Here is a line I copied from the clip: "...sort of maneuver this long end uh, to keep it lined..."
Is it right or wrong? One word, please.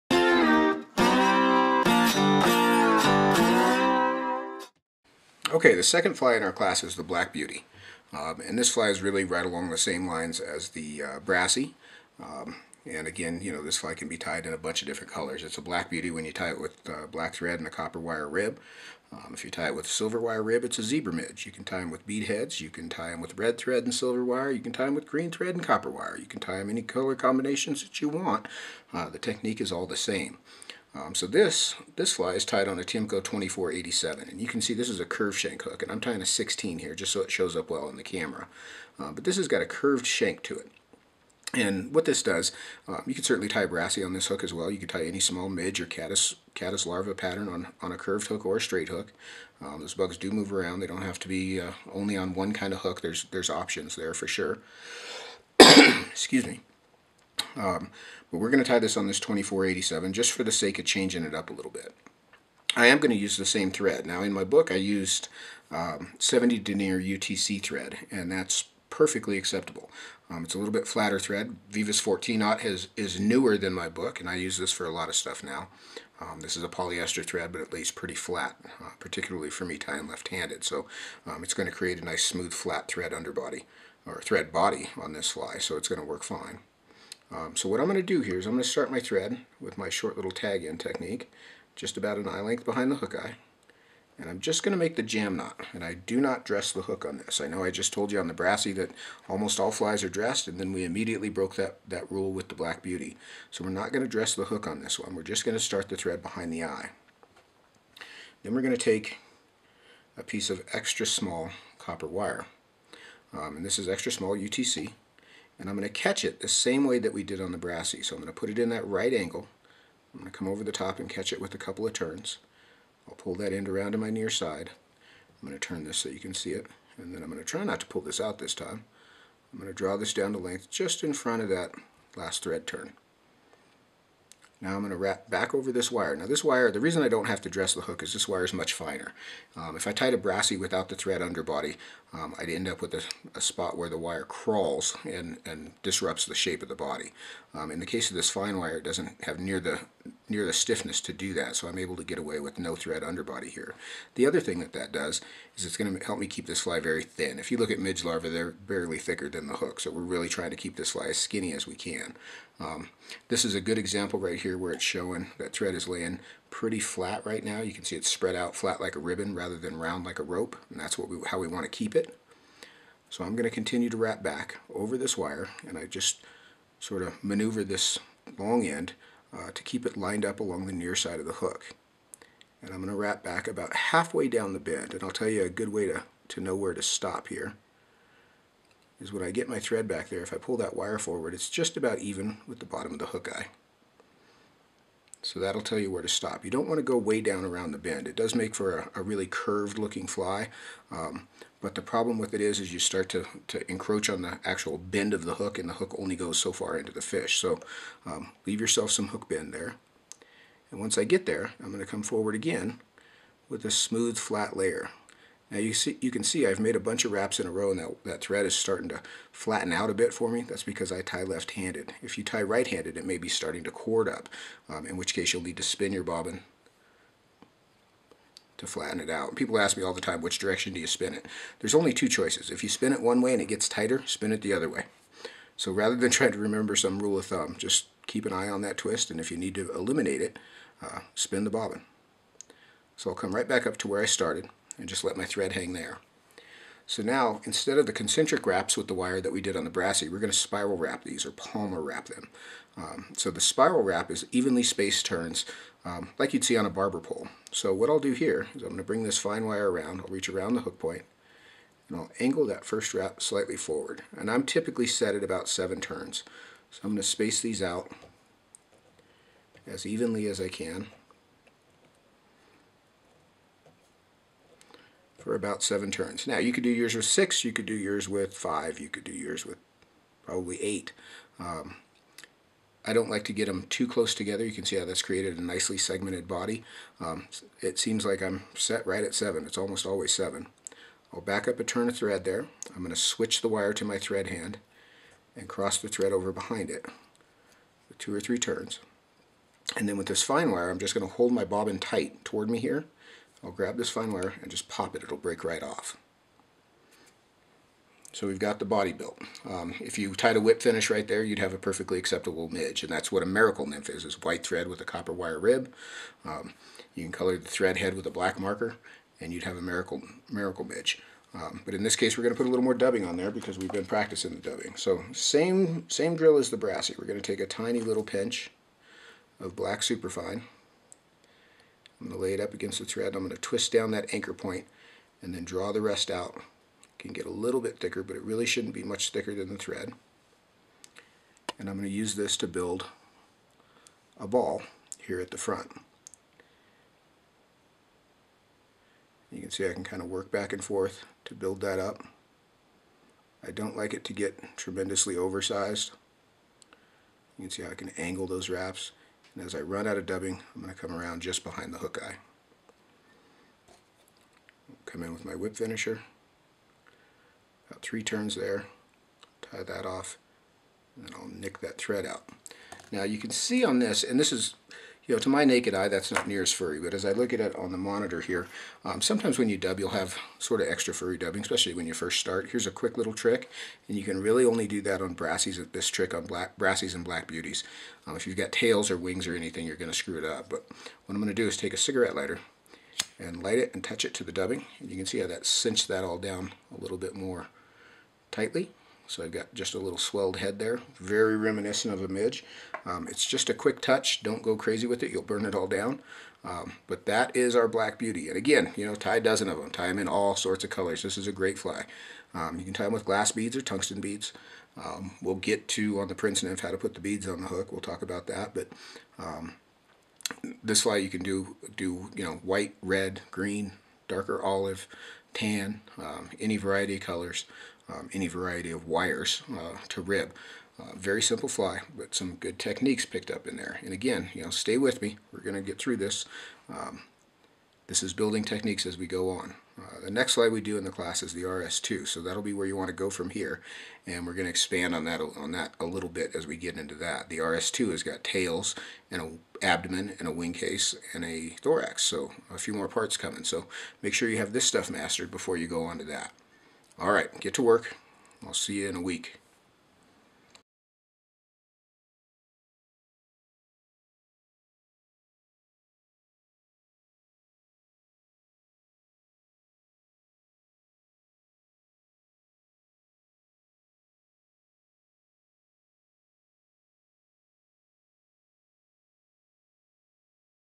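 right.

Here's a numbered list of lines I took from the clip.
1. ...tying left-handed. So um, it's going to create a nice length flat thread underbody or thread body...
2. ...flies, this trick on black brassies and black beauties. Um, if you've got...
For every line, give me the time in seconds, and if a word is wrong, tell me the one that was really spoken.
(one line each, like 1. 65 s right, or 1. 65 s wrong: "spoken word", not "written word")
1. 79 s wrong: "smooth", not "length"
2. 385 s wrong: "brassies", not "flies".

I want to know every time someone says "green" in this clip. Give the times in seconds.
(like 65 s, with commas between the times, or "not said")
25 s, 423 s.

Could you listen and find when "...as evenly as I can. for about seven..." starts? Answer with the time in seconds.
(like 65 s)
269 s.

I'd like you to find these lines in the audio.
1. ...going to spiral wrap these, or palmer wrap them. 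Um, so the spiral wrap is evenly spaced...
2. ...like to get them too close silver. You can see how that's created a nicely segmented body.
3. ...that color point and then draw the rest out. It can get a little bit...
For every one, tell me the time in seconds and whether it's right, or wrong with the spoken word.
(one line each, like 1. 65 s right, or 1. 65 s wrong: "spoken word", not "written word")
1. 250 s right
2. 283 s wrong: "together", not "silver"
3. 333 s wrong: "anchor", not "color".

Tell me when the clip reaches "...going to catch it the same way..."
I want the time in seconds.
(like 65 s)
115 s.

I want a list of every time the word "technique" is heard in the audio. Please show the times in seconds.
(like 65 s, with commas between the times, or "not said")
29 s, 90 s, 432 s, 438 s.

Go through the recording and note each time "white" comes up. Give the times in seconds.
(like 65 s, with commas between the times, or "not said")
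314 s, 422 s.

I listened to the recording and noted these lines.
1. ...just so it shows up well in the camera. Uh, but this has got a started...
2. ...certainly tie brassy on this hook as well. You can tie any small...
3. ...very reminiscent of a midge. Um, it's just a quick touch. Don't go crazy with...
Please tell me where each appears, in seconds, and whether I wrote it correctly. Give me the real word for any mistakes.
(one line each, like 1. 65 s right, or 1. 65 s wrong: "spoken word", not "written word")
1. 36 s wrong: "curved", not "started"
2. 43 s right
3. 400 s right.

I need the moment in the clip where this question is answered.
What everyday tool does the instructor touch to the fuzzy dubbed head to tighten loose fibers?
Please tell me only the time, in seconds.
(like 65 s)
391 s.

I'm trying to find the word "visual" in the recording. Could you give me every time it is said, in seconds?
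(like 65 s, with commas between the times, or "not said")
not said.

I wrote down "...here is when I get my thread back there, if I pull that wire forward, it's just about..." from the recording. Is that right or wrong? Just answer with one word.
right.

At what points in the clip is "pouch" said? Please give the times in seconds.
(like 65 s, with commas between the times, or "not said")
not said.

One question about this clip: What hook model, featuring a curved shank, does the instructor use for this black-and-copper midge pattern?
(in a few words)
Tiemco 2487.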